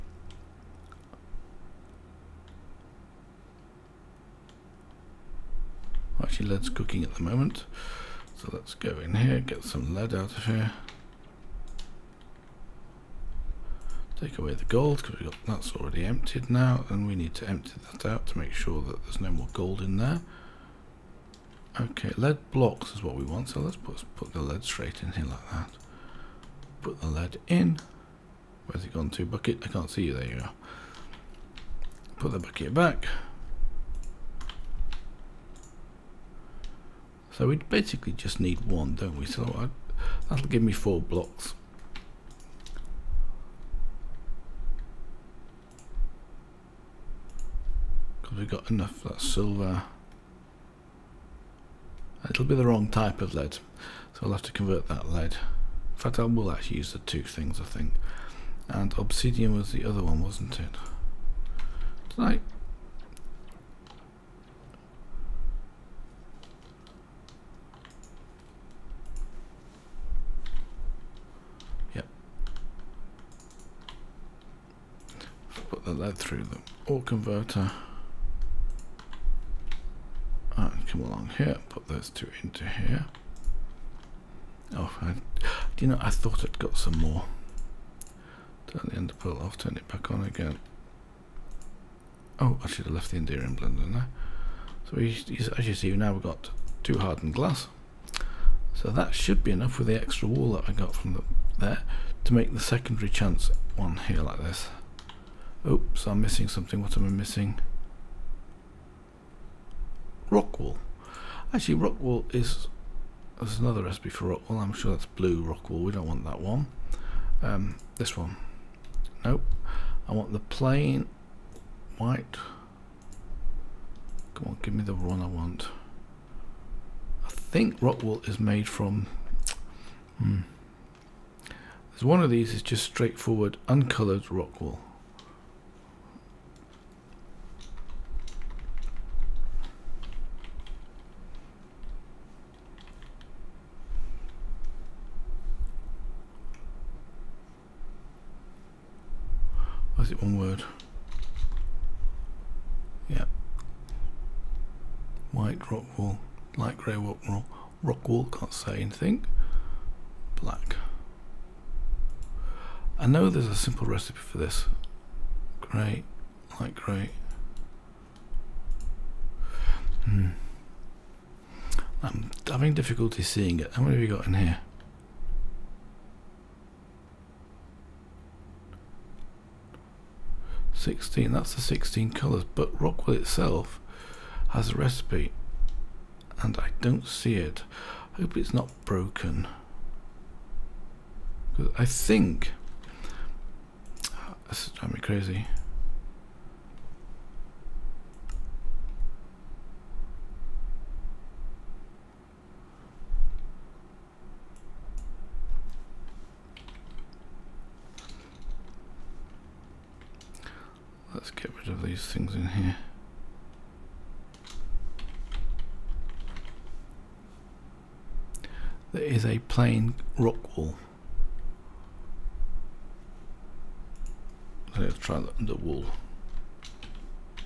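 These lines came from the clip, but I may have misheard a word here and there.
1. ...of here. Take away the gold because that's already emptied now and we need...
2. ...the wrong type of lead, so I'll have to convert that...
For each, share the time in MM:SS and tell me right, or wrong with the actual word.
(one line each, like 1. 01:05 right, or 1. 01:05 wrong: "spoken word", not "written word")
1. 00:10 right
2. 00:52 right.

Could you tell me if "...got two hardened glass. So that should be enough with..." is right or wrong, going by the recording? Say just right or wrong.
right.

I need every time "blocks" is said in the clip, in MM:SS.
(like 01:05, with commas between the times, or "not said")
00:22, 00:41.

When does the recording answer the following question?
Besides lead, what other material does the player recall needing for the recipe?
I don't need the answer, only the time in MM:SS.
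00:58.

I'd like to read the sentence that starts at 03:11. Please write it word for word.
I think this is driving me crazy.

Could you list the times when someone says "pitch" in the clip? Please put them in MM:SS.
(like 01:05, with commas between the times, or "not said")
not said.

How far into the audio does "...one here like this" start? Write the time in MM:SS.
01:43.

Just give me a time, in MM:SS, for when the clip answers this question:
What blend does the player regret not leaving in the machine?
01:33.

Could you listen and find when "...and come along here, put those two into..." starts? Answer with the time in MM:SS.
01:20.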